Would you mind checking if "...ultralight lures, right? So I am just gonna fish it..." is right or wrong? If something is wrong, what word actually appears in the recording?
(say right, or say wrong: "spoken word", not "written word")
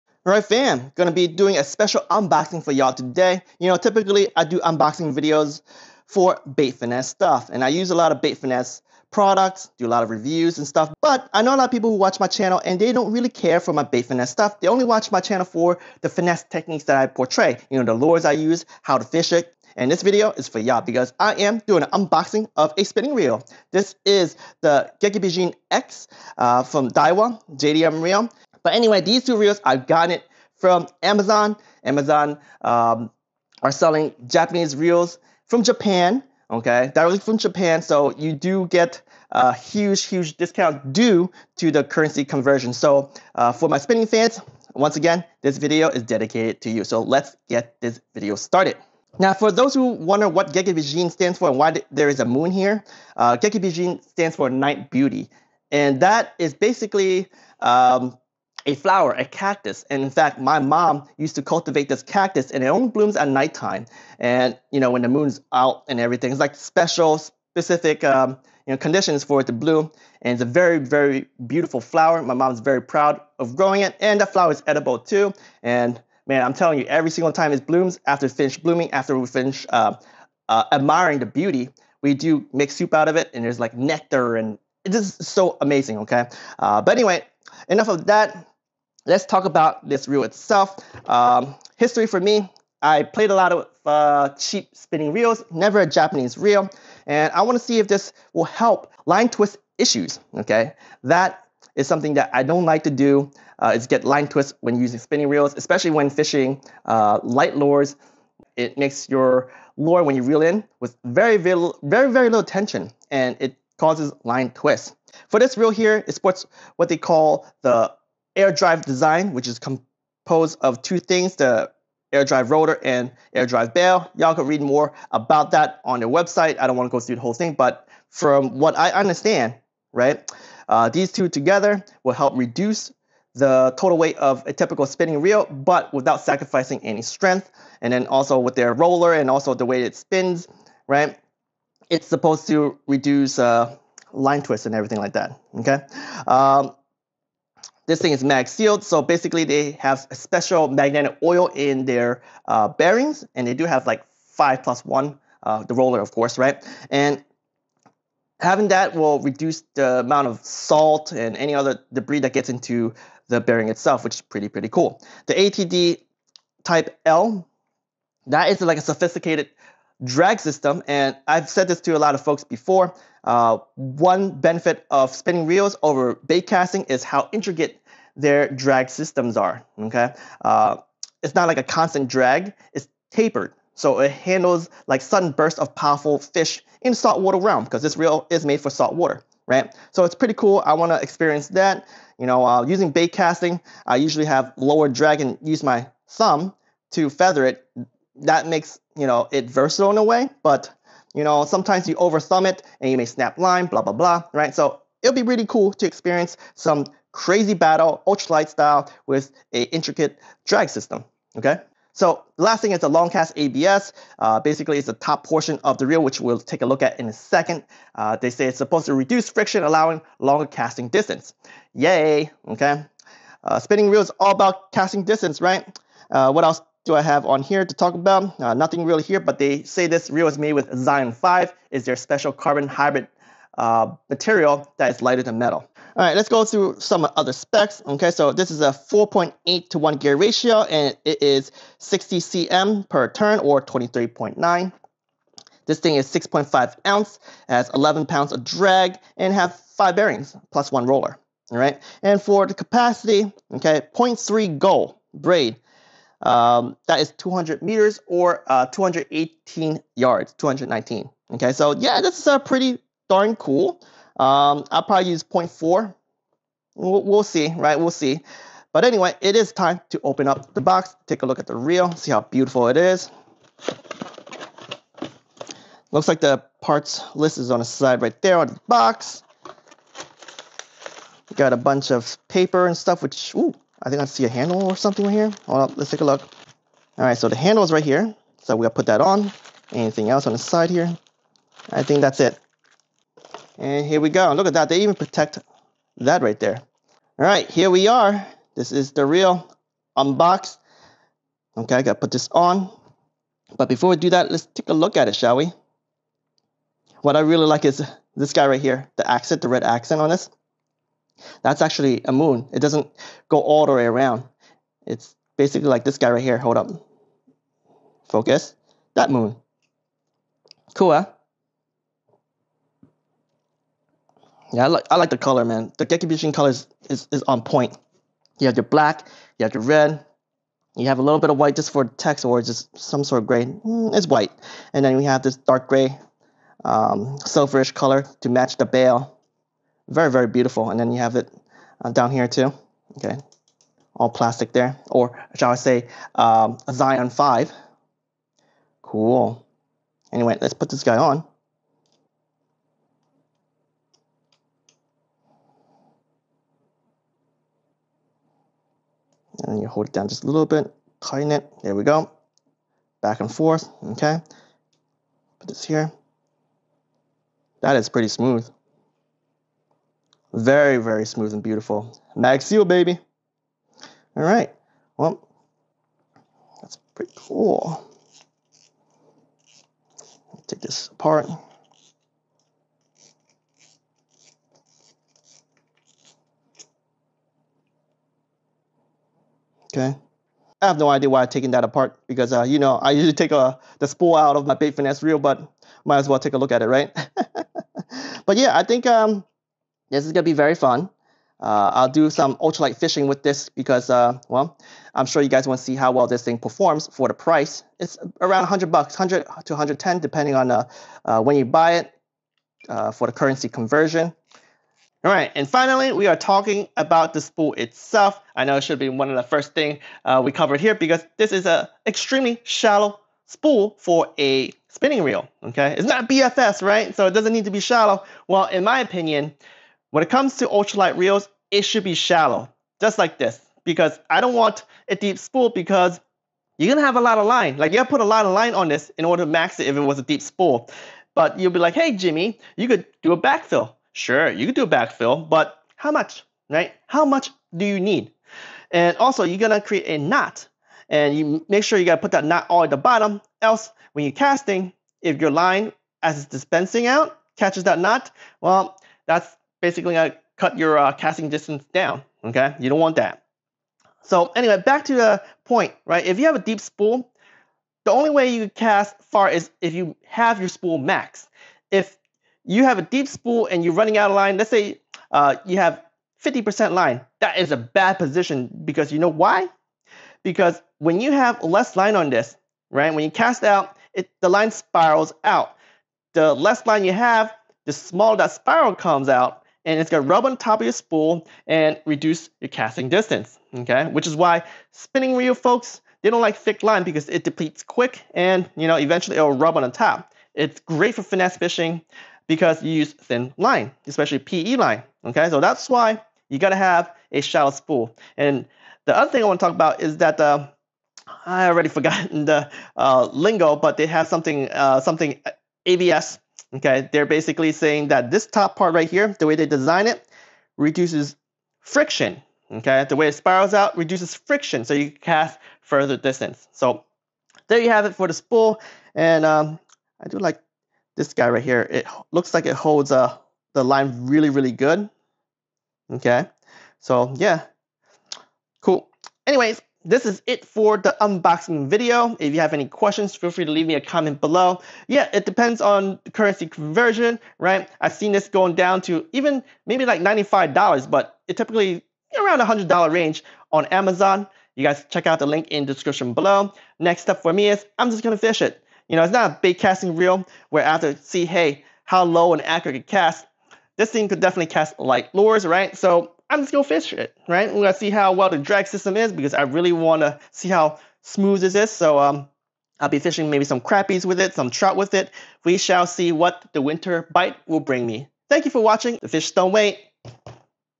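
wrong: "light", not "ultralight".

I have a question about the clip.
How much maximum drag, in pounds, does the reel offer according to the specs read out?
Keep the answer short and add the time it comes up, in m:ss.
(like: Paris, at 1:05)
11 pounds, at 4:07.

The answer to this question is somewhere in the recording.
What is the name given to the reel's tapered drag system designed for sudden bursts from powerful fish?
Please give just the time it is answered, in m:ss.
2:45.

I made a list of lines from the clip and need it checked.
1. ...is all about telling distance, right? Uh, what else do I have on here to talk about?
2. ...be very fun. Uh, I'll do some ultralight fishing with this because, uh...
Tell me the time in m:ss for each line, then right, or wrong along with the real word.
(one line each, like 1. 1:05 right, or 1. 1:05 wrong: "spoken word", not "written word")
1. 3:43 wrong: "casting", not "telling"
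2. 6:40 right.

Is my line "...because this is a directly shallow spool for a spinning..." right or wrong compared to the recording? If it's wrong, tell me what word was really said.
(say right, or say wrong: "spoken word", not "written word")
wrong: "extremely", not "directly".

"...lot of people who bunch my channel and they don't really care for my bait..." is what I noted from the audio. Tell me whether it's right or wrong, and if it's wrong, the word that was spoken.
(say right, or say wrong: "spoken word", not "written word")
wrong: "watch", not "bunch".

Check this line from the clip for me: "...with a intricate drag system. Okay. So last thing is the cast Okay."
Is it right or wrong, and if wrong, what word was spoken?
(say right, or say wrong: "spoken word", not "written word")
wrong: "ABS", not "Okay".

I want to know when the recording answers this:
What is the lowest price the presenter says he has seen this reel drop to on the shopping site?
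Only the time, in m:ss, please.
9:10.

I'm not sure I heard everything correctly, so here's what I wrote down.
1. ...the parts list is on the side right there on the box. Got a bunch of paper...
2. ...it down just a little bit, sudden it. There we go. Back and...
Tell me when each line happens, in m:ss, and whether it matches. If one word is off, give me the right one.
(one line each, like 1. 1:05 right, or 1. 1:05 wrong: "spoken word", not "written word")
1. 4:36 right
2. 5:59 wrong: "tighten", not "sudden".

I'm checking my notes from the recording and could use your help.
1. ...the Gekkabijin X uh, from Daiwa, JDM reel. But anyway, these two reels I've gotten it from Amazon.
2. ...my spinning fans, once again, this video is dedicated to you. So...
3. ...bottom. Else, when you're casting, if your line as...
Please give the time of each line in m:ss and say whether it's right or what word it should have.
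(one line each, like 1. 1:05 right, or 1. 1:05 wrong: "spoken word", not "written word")
1. 0:24 right
2. 0:43 right
3. 7:32 right.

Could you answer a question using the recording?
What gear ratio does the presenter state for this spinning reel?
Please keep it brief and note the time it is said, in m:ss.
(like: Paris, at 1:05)
4.8 to 1, at 3:58.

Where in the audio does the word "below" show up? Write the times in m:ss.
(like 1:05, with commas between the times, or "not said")
9:04, 9:16.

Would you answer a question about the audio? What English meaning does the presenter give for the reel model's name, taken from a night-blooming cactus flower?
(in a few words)
night beauty.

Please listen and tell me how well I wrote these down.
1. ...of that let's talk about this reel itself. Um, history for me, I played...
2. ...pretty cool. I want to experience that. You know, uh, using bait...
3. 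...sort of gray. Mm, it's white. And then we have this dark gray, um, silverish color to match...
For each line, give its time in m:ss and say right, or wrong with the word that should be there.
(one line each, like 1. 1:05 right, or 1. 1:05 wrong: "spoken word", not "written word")
1. 1:27 right
2. 3:10 right
3. 5:33 right.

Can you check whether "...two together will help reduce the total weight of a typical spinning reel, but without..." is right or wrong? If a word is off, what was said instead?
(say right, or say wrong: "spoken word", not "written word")
right.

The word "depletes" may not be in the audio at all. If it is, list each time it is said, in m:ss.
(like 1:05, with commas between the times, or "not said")
8:17.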